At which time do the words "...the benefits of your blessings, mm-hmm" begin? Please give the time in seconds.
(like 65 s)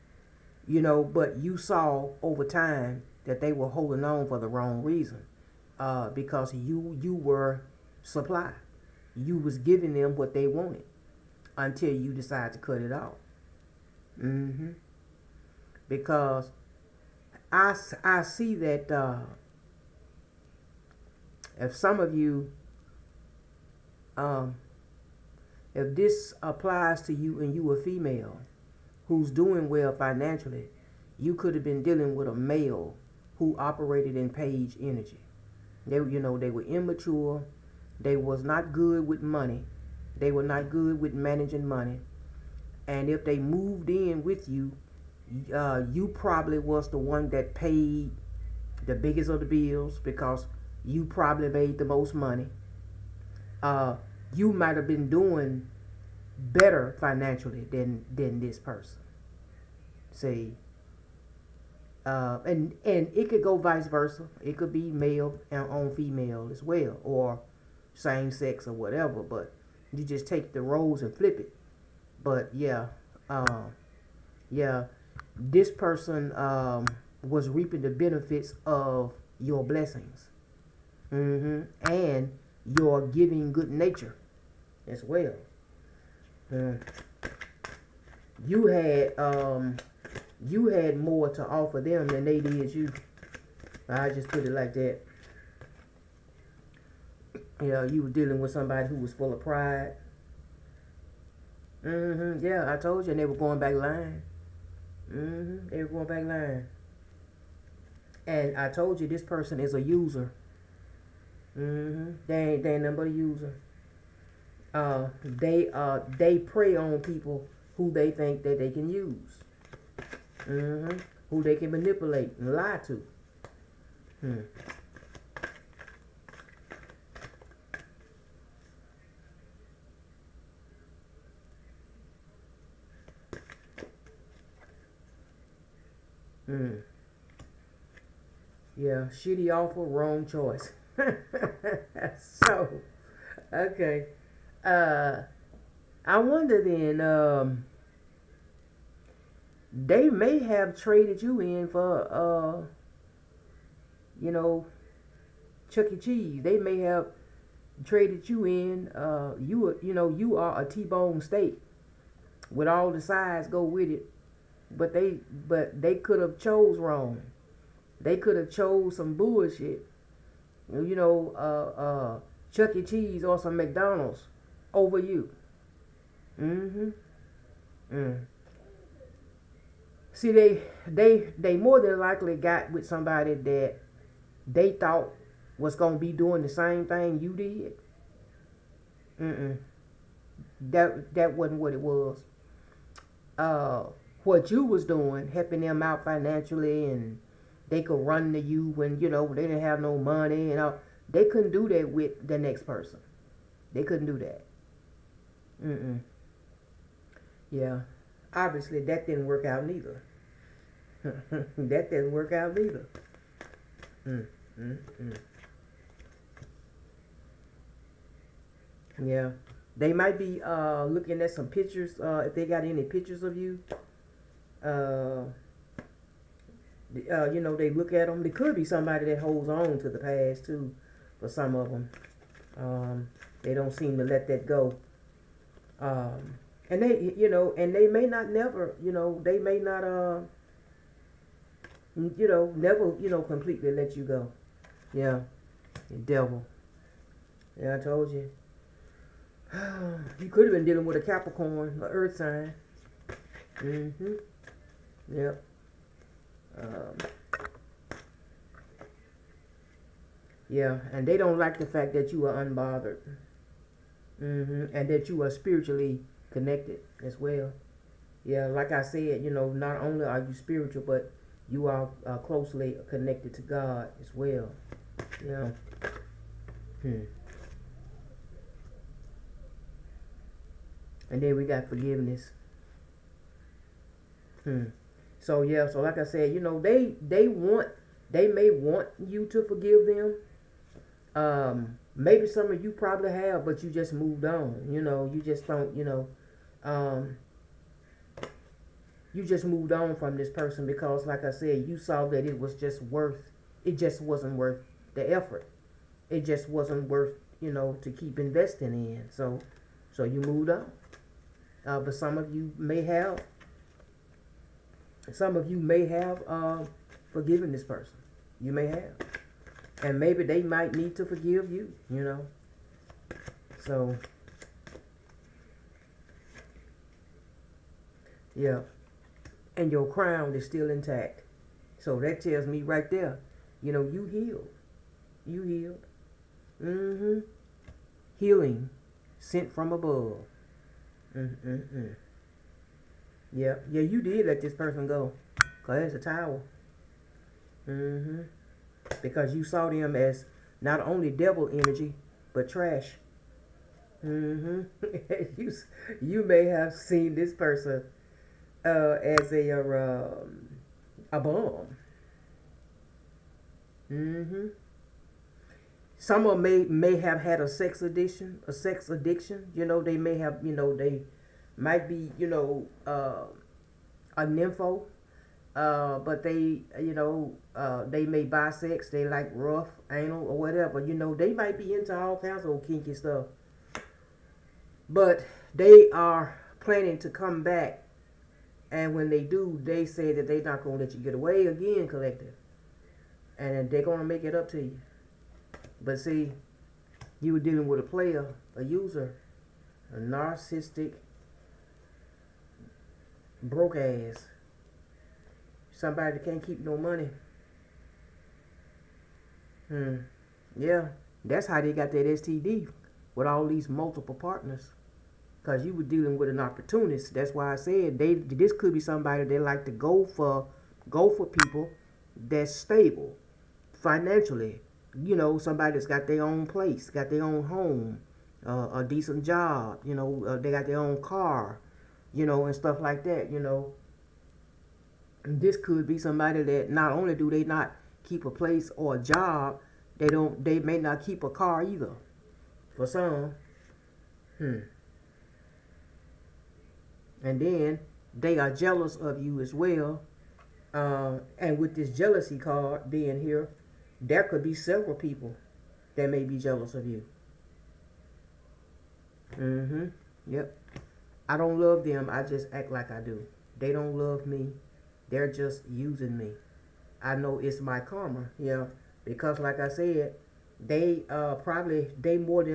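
77 s.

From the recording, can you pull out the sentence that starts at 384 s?
But they are planning to come back.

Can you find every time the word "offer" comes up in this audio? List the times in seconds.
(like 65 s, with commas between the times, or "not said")
91 s.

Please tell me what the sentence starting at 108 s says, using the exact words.
And I told you, this person is a user.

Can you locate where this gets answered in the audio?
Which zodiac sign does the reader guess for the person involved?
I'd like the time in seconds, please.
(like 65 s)
251 s.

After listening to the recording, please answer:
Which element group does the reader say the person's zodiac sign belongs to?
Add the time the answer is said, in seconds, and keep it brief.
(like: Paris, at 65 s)
Earth sign, at 251 s.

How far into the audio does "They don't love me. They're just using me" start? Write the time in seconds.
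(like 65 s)
463 s.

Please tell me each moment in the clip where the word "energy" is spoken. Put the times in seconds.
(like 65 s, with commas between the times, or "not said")
34 s, 351 s.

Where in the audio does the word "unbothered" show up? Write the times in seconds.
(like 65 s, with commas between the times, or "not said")
262 s.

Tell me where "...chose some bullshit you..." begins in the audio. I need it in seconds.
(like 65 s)
168 s.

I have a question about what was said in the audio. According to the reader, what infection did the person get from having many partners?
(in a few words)
STD.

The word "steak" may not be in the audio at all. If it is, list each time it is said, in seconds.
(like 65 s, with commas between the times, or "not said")
161 s.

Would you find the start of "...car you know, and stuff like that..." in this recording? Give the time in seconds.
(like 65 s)
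431 s.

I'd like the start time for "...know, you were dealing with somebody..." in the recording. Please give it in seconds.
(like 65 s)
97 s.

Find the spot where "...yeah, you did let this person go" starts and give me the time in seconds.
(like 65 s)
343 s.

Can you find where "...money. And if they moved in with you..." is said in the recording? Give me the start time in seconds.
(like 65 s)
41 s.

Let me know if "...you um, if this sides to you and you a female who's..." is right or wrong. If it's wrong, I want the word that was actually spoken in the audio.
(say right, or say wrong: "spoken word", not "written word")
wrong: "applies", not "sides".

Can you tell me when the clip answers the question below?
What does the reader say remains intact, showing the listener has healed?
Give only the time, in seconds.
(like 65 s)
329 s.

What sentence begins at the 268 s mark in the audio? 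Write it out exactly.
Yeah, like I said, you know, not only are you spiritual, but you are uh, closely connected to God as well.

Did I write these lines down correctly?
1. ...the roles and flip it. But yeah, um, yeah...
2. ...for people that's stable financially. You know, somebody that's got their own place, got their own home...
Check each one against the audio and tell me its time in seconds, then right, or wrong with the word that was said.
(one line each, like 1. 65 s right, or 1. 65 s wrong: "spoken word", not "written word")
1. 70 s right
2. 421 s right.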